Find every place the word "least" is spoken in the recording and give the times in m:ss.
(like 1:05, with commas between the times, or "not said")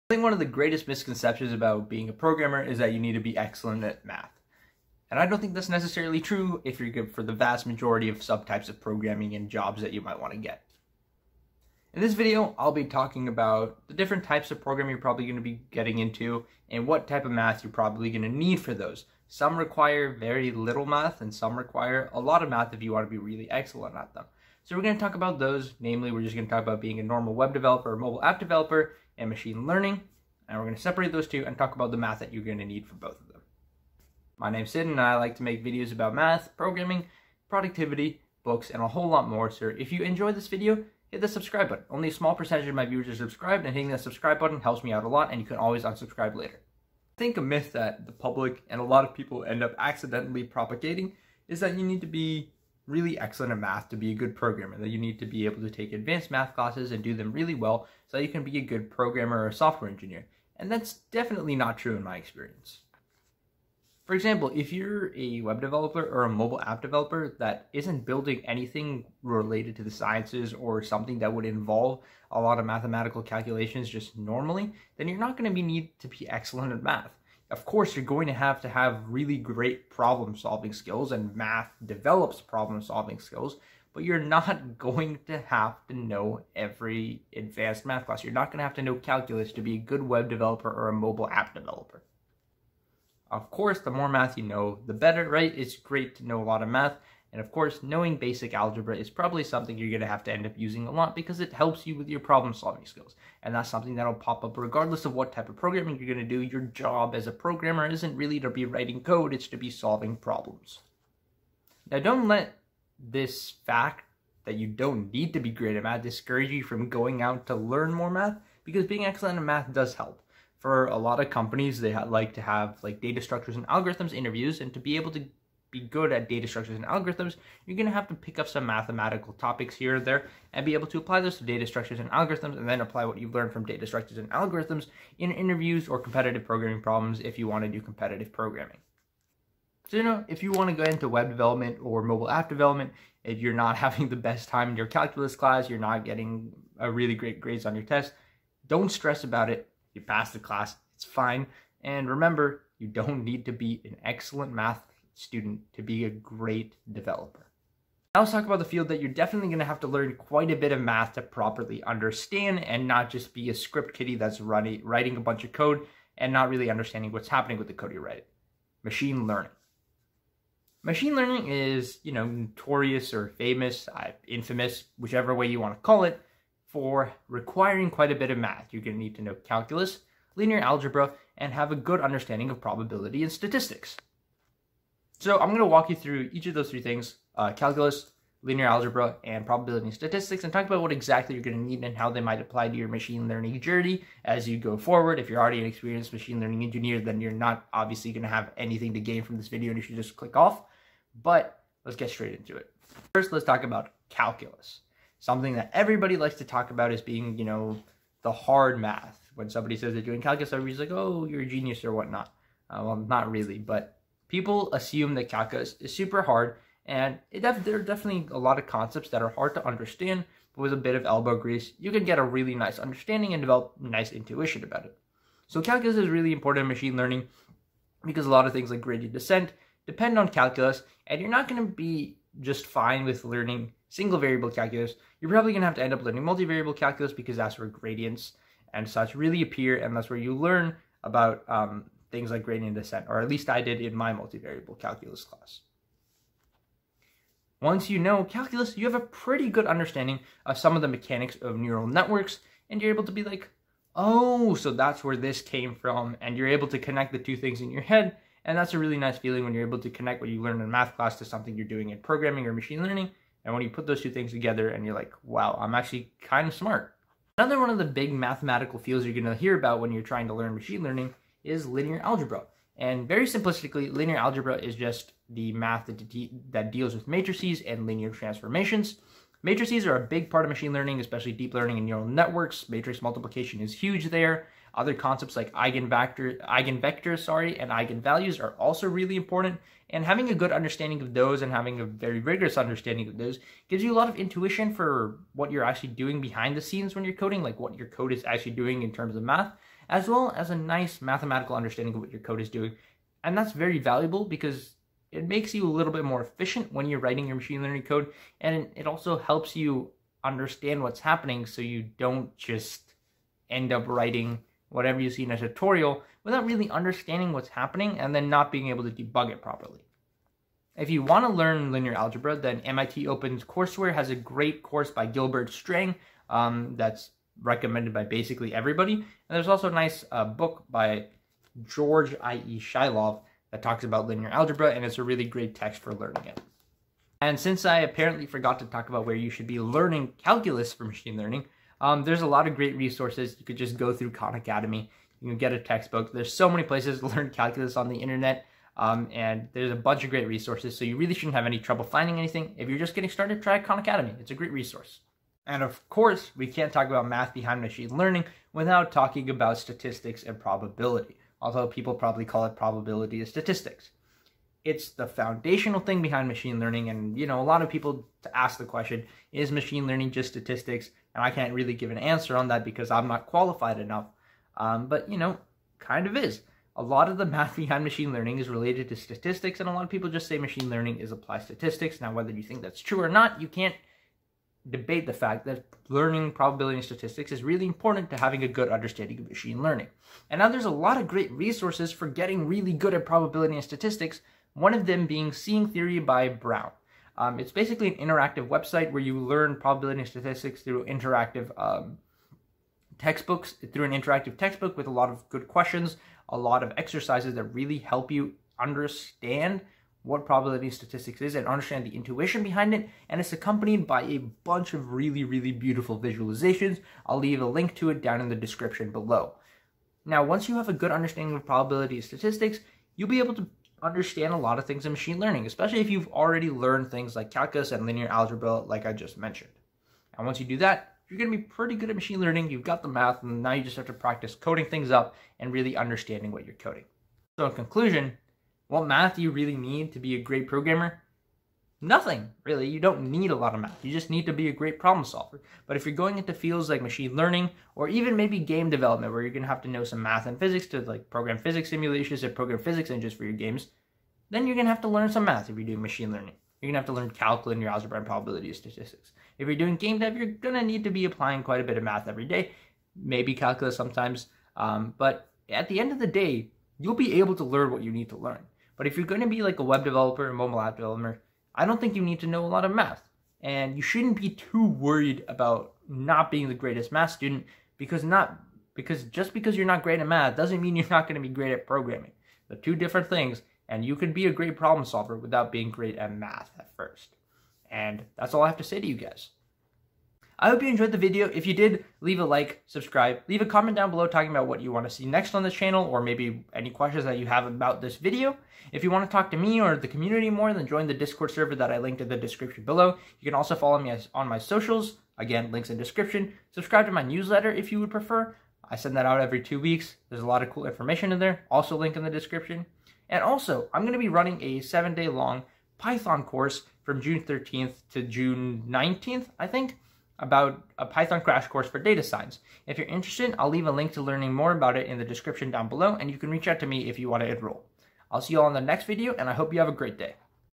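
4:03.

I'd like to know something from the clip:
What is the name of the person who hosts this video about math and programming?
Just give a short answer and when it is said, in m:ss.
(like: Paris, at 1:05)
Sid, at 0:34.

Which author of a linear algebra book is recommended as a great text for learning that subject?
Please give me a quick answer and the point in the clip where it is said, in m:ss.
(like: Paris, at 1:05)
Shilov, at 5:32.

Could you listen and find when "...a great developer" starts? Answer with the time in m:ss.
2:36.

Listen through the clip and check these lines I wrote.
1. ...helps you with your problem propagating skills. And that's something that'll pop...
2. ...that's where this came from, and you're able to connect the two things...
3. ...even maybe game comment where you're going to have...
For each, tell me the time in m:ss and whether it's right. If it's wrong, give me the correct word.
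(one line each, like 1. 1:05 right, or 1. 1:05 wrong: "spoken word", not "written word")
1. 1:41 wrong: "solving", not "propagating"
2. 4:14 right
3. 7:27 wrong: "development", not "comment".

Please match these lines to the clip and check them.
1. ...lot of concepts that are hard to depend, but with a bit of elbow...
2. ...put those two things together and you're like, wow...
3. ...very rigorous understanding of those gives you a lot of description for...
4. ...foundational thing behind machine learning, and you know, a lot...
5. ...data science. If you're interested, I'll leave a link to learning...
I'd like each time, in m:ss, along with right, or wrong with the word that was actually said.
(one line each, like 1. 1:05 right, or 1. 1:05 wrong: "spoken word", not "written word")
1. 3:38 wrong: "understand", not "depend"
2. 4:23 right
3. 4:51 wrong: "intuition", not "description"
4. 6:05 right
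5. 8:41 right.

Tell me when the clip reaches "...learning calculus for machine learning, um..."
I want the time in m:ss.
5:39.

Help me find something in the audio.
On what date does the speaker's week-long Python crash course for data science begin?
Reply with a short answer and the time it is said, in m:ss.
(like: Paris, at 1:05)
June 13, at 8:36.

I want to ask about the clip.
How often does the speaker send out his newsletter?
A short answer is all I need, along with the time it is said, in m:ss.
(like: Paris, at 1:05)
every two weeks, at 8:29.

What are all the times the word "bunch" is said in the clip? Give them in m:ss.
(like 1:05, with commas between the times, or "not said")
2:45, 5:49, 6:54.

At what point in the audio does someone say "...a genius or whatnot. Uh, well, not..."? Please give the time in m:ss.
3:31.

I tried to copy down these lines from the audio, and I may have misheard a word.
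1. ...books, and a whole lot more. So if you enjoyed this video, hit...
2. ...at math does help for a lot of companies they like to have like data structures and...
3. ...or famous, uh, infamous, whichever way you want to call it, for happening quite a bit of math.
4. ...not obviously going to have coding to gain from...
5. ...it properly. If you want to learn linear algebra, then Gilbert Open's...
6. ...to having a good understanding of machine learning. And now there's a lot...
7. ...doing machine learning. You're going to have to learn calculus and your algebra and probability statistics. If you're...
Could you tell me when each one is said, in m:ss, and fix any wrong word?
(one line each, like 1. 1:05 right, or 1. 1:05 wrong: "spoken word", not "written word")
1. 0:38 right
2. 1:59 right
3. 2:53 wrong: "requiring", not "happening"
4. 3:17 wrong: "anything", not "coding"
5. 5:19 wrong: "MIT", not "Gilbert"
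6. 6:28 right
7. 7:35 right.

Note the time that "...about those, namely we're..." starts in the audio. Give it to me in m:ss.
0:25.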